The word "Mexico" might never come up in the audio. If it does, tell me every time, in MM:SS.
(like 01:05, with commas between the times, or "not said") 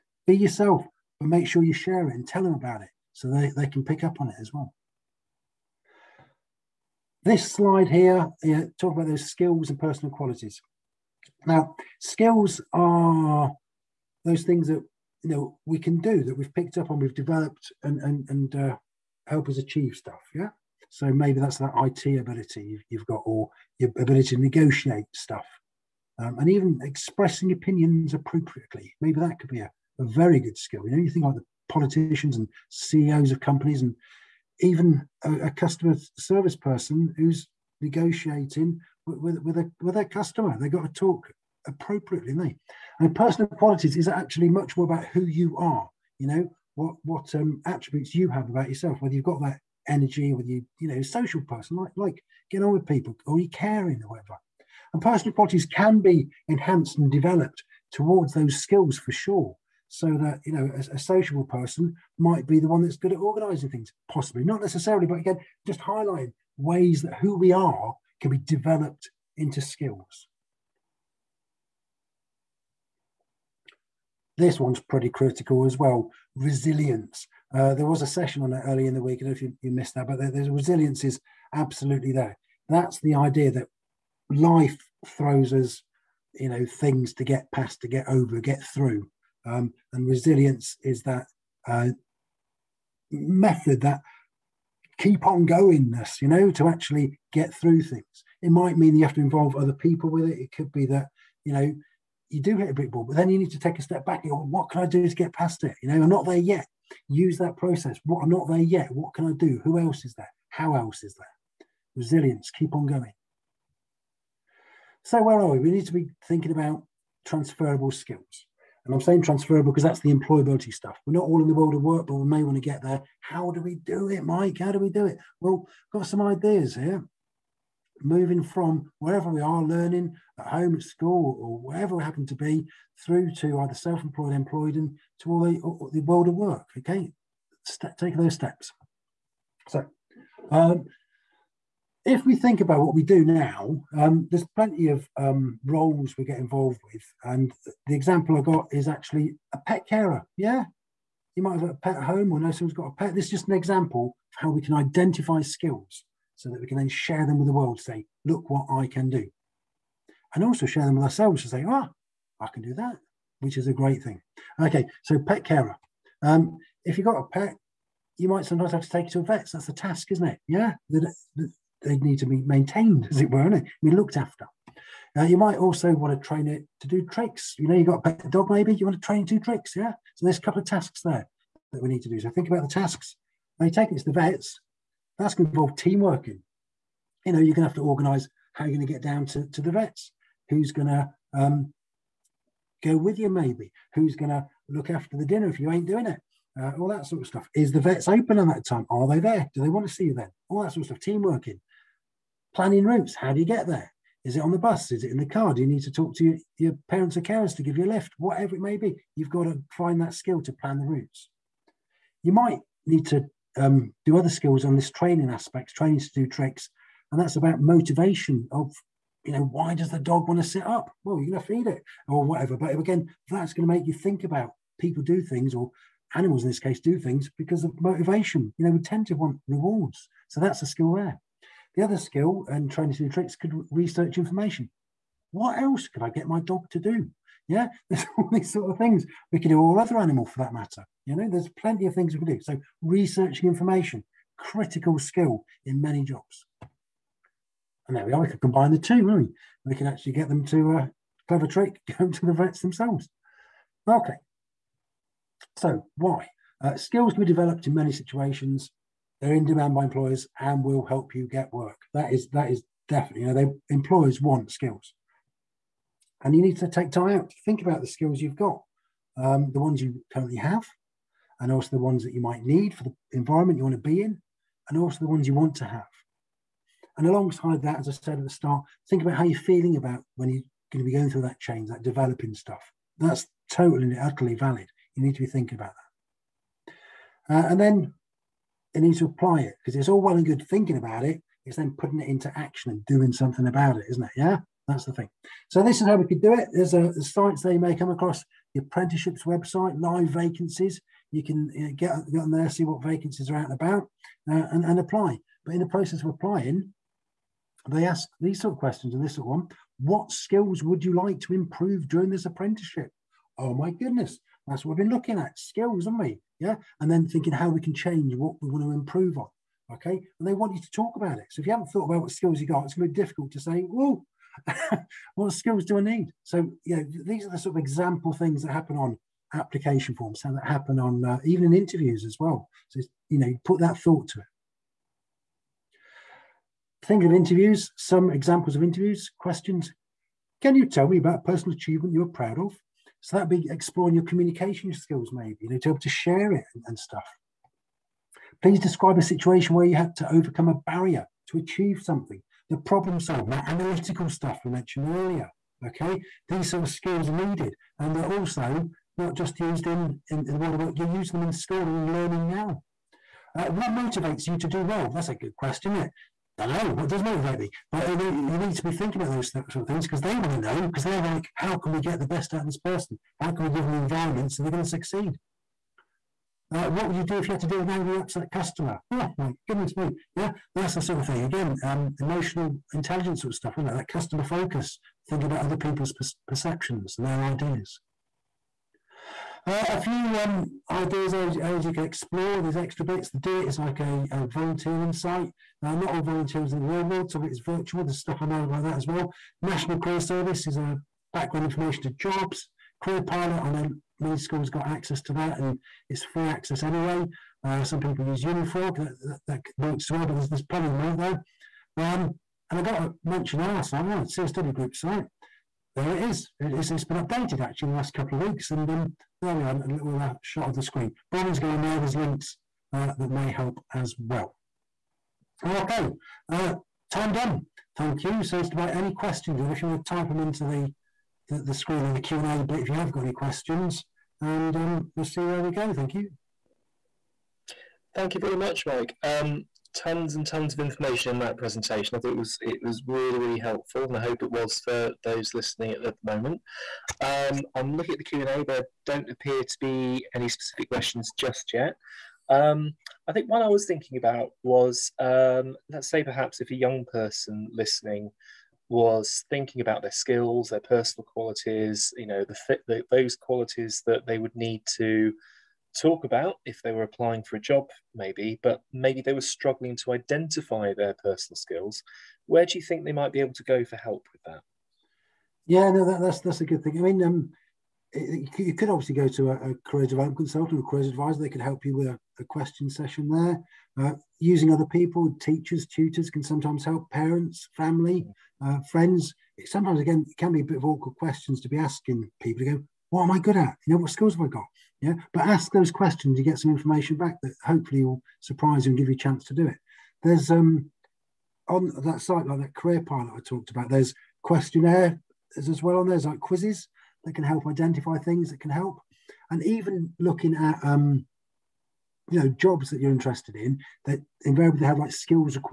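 not said.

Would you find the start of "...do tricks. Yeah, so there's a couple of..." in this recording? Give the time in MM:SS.
02:59.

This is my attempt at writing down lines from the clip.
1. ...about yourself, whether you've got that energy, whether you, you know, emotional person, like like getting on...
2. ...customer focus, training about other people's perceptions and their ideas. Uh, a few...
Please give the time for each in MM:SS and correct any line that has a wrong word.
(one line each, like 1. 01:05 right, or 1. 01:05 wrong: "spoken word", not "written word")
1. 00:48 wrong: "social", not "emotional"
2. 06:23 wrong: "thinking", not "training".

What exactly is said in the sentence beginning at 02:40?
And also share them with ourselves to say, ah, I can do that, which is a great thing.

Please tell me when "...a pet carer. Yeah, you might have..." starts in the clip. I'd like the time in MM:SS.
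02:29.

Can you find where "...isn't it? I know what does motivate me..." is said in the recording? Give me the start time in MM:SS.
06:05.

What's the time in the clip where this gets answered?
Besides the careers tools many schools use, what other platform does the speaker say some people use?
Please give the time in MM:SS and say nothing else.
06:48.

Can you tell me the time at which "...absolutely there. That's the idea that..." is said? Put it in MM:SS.
01:21.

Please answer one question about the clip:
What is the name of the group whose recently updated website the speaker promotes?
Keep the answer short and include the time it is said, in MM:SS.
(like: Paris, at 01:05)
CSW group, at 06:54.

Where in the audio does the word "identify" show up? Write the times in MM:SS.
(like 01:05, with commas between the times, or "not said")
02:34, 07:49, 08:27.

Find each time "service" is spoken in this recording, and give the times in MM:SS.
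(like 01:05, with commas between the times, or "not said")
00:36, 06:40.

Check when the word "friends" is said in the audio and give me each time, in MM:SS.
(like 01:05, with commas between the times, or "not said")
08:08.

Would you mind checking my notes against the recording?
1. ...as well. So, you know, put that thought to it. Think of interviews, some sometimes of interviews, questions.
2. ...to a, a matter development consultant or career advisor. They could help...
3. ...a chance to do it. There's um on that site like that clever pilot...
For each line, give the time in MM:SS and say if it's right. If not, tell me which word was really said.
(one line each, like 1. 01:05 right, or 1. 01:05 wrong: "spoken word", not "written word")
1. 05:32 wrong: "examples", not "sometimes"
2. 07:59 wrong: "career", not "matter"
3. 08:18 wrong: "career", not "clever".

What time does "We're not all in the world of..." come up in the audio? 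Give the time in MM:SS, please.
02:01.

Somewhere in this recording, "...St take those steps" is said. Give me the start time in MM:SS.
02:17.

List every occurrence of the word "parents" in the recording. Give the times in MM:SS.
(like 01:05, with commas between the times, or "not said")
03:26, 08:06.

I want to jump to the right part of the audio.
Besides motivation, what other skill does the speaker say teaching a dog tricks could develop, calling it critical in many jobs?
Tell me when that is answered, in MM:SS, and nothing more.
03:53.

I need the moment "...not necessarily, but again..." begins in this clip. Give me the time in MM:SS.
01:04.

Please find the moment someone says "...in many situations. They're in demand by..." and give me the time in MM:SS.
04:17.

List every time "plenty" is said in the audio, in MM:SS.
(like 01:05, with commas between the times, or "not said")
02:24, 04:01, 06:50.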